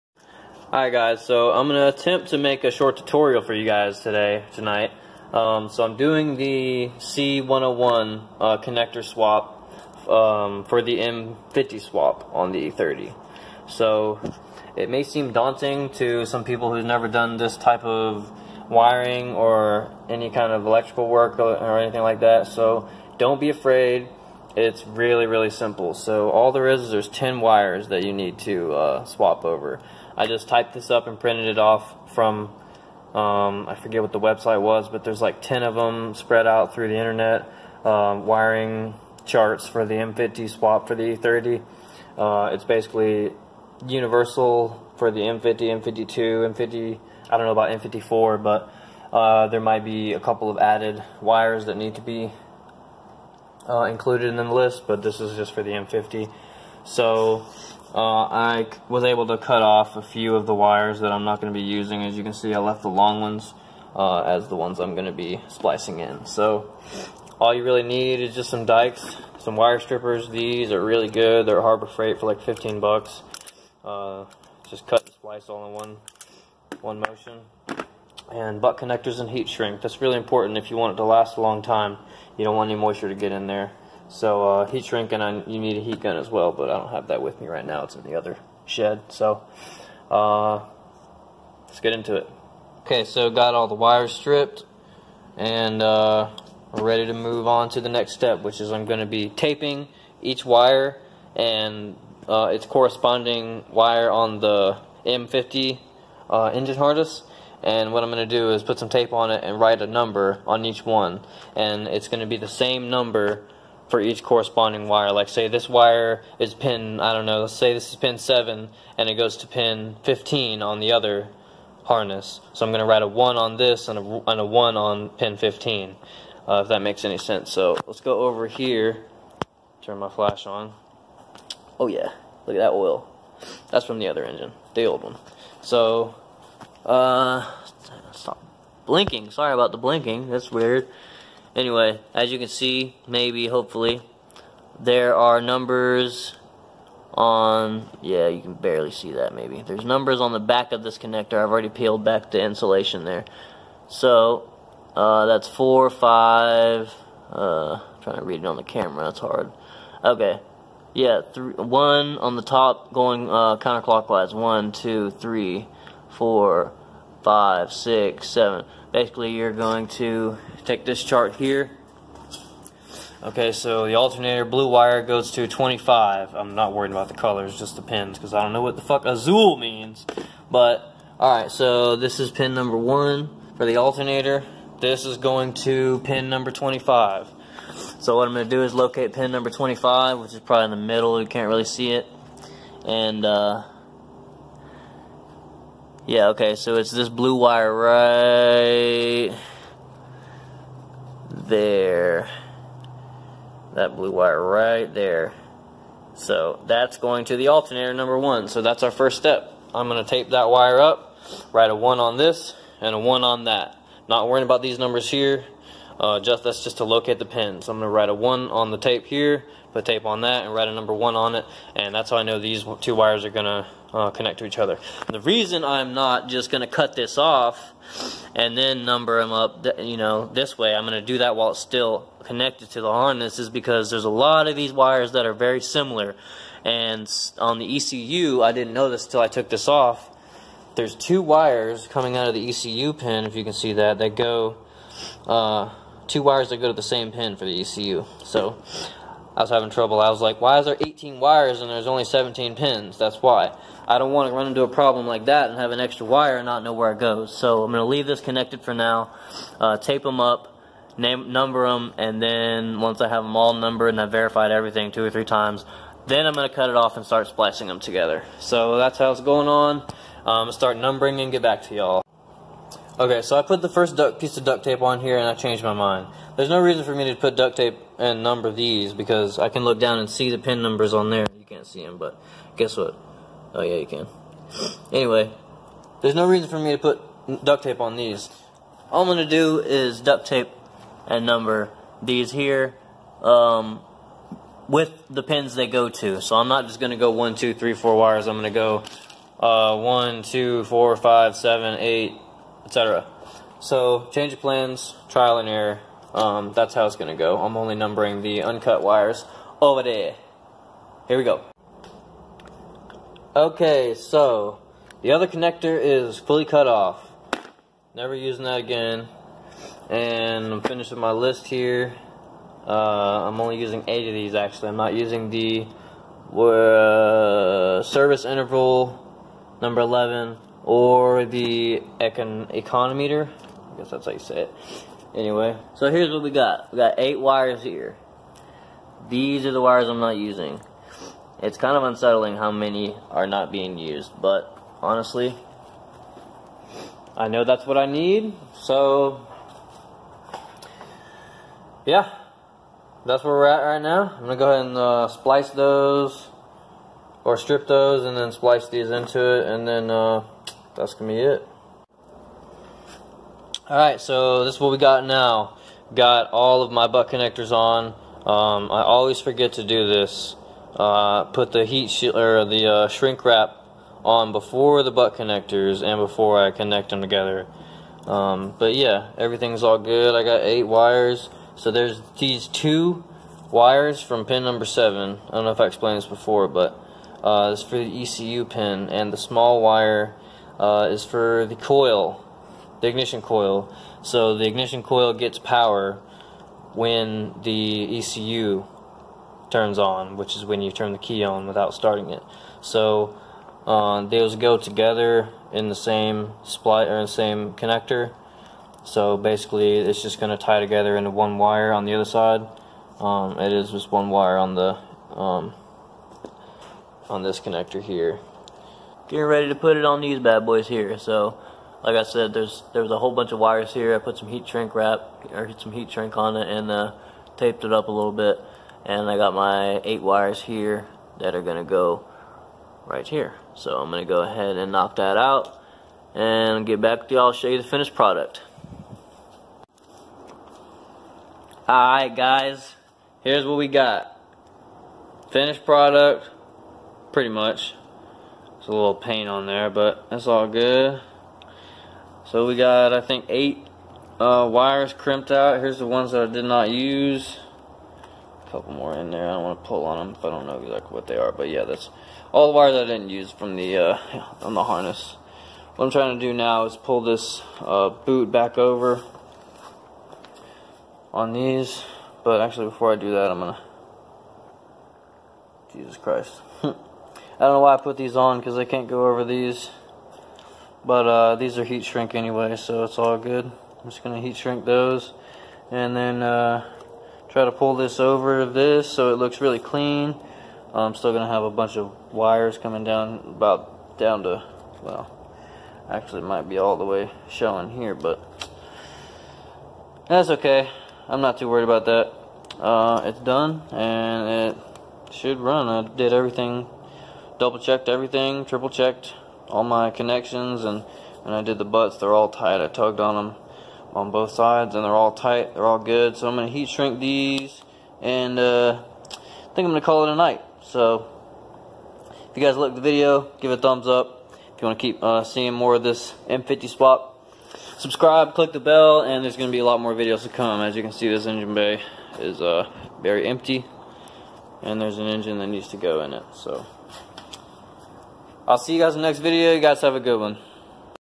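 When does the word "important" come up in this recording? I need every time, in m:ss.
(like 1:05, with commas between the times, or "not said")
1:20.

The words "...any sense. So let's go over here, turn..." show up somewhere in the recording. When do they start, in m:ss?
2:07.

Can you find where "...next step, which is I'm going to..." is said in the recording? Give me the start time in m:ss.
1:37.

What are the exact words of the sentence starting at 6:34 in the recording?
So the ignition coil gets power when the ECU turns on, which is when you turn the key on without starting it.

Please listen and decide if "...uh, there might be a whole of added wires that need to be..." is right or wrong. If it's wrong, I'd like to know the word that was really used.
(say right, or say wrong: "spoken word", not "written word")
wrong: "couple", not "whole".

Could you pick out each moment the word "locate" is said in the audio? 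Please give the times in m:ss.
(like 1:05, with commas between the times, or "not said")
3:08, 3:36.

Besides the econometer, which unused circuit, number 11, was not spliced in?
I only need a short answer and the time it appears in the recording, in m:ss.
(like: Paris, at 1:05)
service interval, at 5:27.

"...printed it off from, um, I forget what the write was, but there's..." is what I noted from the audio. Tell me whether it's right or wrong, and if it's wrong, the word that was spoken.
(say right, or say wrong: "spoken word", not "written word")
wrong: "website", not "write".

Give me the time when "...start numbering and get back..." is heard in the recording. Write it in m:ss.
4:30.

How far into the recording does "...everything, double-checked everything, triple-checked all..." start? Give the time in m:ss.
8:26.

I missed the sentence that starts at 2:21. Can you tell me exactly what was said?
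Anyway, as you can see, maybe, hopefully, there are numbers on, yeah, you can barely see that maybe.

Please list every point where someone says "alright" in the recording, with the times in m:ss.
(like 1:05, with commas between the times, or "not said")
0:00, 3:01, 6:03, 7:21.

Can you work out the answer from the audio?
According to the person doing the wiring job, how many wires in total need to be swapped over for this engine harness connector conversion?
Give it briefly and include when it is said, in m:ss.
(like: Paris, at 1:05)
10, at 0:27.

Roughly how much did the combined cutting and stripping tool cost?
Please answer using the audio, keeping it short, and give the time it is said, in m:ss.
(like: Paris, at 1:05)
15 bucks, at 1:12.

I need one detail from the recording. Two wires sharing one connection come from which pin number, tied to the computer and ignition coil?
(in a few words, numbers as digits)
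7.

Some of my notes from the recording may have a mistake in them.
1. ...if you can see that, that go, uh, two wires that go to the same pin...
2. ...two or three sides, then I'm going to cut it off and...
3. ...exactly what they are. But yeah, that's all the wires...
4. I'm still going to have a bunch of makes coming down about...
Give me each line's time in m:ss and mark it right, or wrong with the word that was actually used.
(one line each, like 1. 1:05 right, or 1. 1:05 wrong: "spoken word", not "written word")
1. 4:03 right
2. 4:24 wrong: "times", not "sides"
3. 7:40 right
4. 8:10 wrong: "wires", not "makes".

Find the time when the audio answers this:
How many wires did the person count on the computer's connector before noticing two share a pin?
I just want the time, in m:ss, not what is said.
4:10.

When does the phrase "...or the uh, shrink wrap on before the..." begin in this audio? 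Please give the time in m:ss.
6:12.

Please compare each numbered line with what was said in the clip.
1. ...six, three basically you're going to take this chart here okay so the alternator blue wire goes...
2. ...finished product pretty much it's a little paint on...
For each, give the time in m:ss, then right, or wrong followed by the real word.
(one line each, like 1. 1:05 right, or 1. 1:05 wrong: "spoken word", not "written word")
1. 2:47 wrong: "seven", not "three"
2. 7:25 right.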